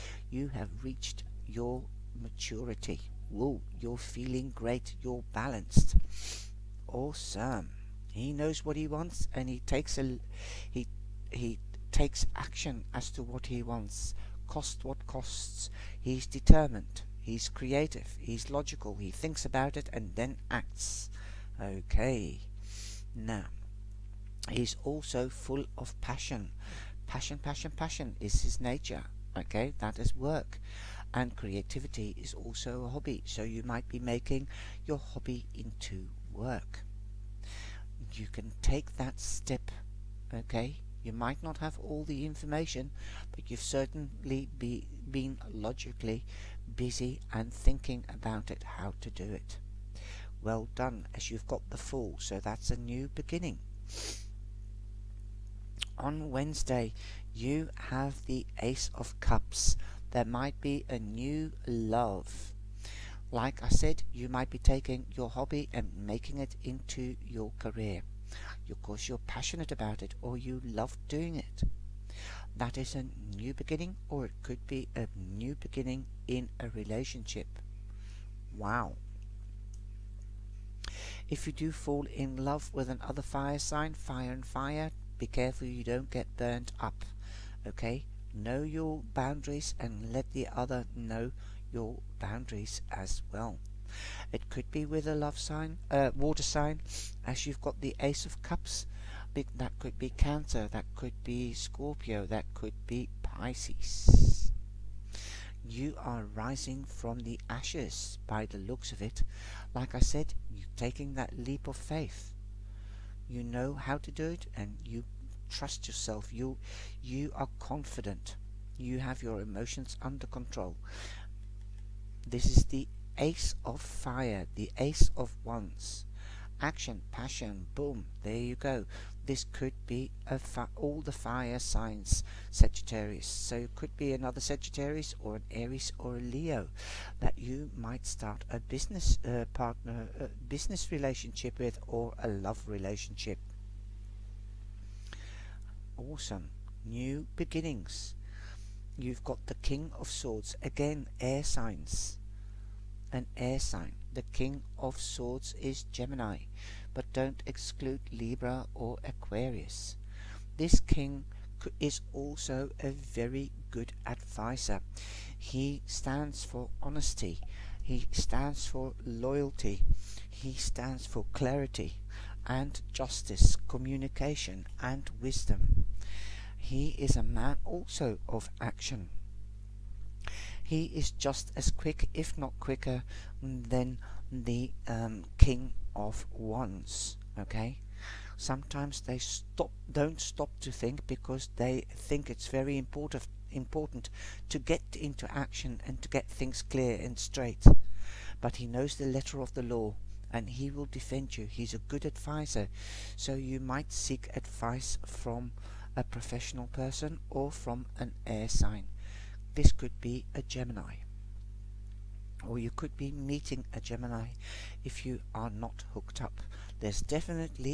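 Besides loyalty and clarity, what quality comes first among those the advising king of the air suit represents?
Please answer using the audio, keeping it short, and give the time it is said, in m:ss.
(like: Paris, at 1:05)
Honesty, at 2:46.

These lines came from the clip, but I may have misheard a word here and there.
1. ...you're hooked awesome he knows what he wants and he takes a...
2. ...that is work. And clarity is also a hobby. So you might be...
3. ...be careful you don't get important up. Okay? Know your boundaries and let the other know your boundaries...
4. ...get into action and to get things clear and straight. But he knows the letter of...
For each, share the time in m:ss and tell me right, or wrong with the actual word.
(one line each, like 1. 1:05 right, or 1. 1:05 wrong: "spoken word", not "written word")
1. 0:05 wrong: "balanced", not "hooked"
2. 0:29 wrong: "creativity", not "clarity"
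3. 1:25 wrong: "burnt", not "important"
4. 3:14 right.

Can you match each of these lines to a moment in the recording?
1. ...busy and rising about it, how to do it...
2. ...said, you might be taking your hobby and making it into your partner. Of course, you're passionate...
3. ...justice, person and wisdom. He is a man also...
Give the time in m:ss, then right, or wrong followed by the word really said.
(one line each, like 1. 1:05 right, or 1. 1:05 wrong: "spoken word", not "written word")
1. 0:46 wrong: "thinking", not "rising"
2. 1:03 wrong: "career", not "partner"
3. 2:52 wrong: "communication", not "person".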